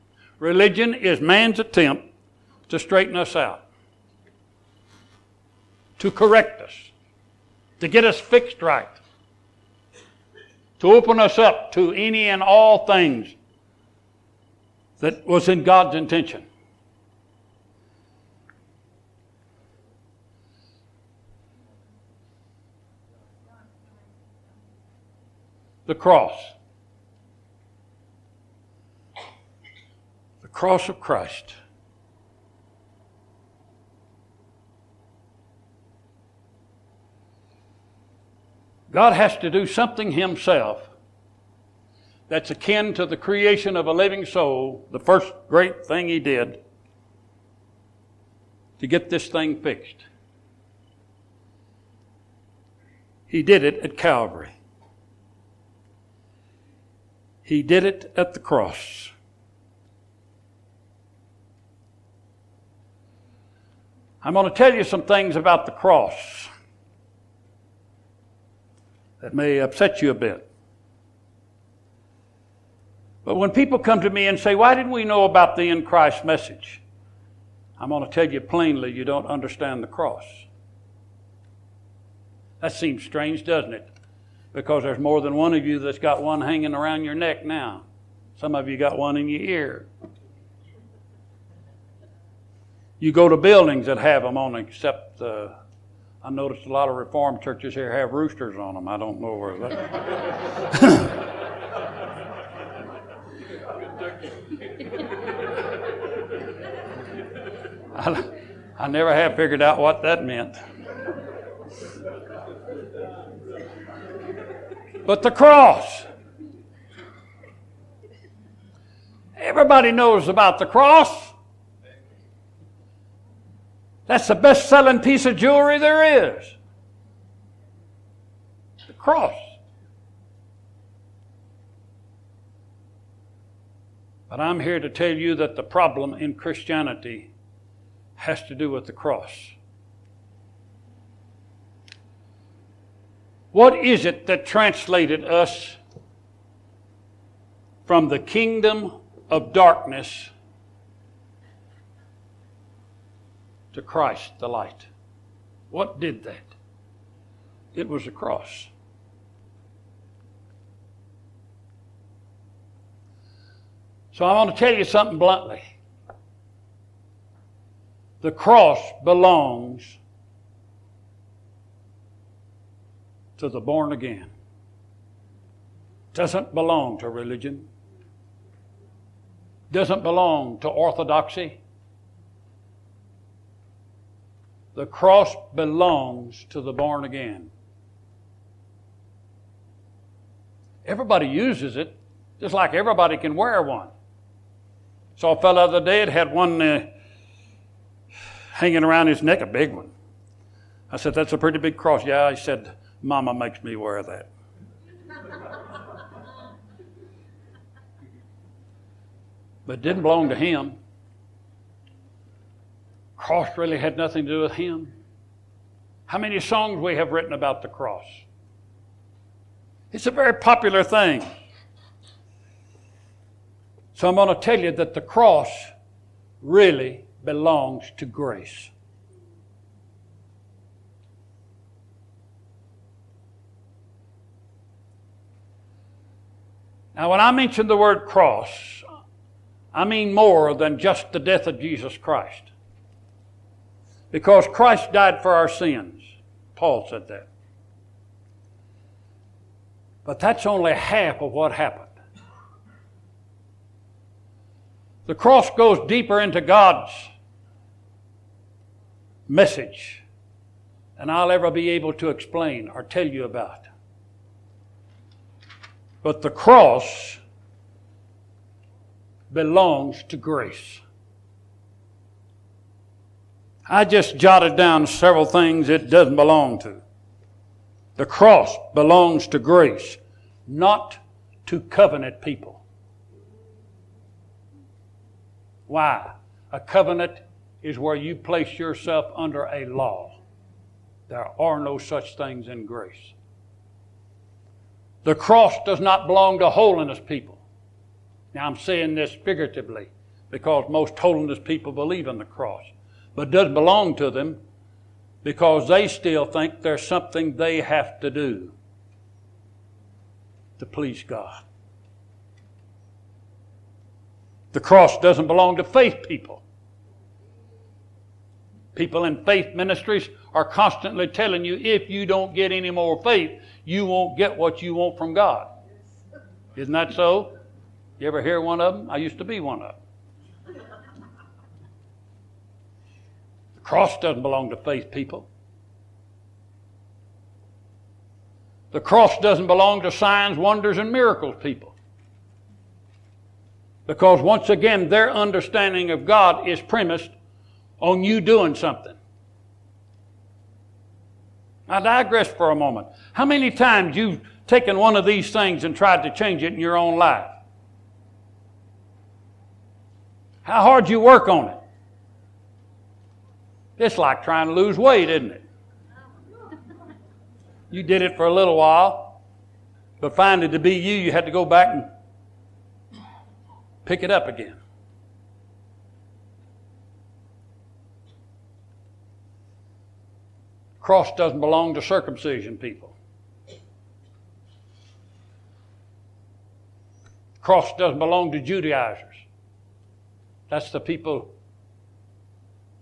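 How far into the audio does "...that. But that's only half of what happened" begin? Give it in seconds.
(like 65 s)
247 s.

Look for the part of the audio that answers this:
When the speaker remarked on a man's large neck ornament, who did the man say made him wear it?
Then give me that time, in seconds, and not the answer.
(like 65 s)
203 s.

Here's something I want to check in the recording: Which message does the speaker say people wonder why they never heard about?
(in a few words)
The in Christ message.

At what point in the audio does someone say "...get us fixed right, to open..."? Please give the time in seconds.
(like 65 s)
7 s.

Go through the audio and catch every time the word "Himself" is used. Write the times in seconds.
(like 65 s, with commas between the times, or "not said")
40 s.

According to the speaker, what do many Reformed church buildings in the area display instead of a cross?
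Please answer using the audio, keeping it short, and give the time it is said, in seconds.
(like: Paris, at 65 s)
Roosters, at 98 s.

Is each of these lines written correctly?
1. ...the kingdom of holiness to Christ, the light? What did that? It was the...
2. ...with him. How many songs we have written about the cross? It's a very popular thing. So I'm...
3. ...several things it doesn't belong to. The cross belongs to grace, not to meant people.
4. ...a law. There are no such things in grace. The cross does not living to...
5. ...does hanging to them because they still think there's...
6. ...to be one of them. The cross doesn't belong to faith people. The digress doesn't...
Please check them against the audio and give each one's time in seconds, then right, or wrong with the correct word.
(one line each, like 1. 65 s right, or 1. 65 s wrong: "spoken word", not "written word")
1. 148 s wrong: "darkness", not "holiness"
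2. 214 s right
3. 274 s wrong: "covenant", not "meant"
4. 289 s wrong: "belong", not "living"
5. 303 s wrong: "belong", not "hanging"
6. 329 s wrong: "cross", not "digress".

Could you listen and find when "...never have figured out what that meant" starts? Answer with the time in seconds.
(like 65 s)
108 s.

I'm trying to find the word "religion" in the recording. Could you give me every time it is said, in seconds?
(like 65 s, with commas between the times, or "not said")
0 s, 177 s.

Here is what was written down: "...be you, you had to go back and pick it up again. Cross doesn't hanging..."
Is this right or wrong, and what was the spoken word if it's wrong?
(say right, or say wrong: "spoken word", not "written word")
wrong: "belong", not "hanging".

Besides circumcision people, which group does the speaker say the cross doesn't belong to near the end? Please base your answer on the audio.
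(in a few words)
Judaizers.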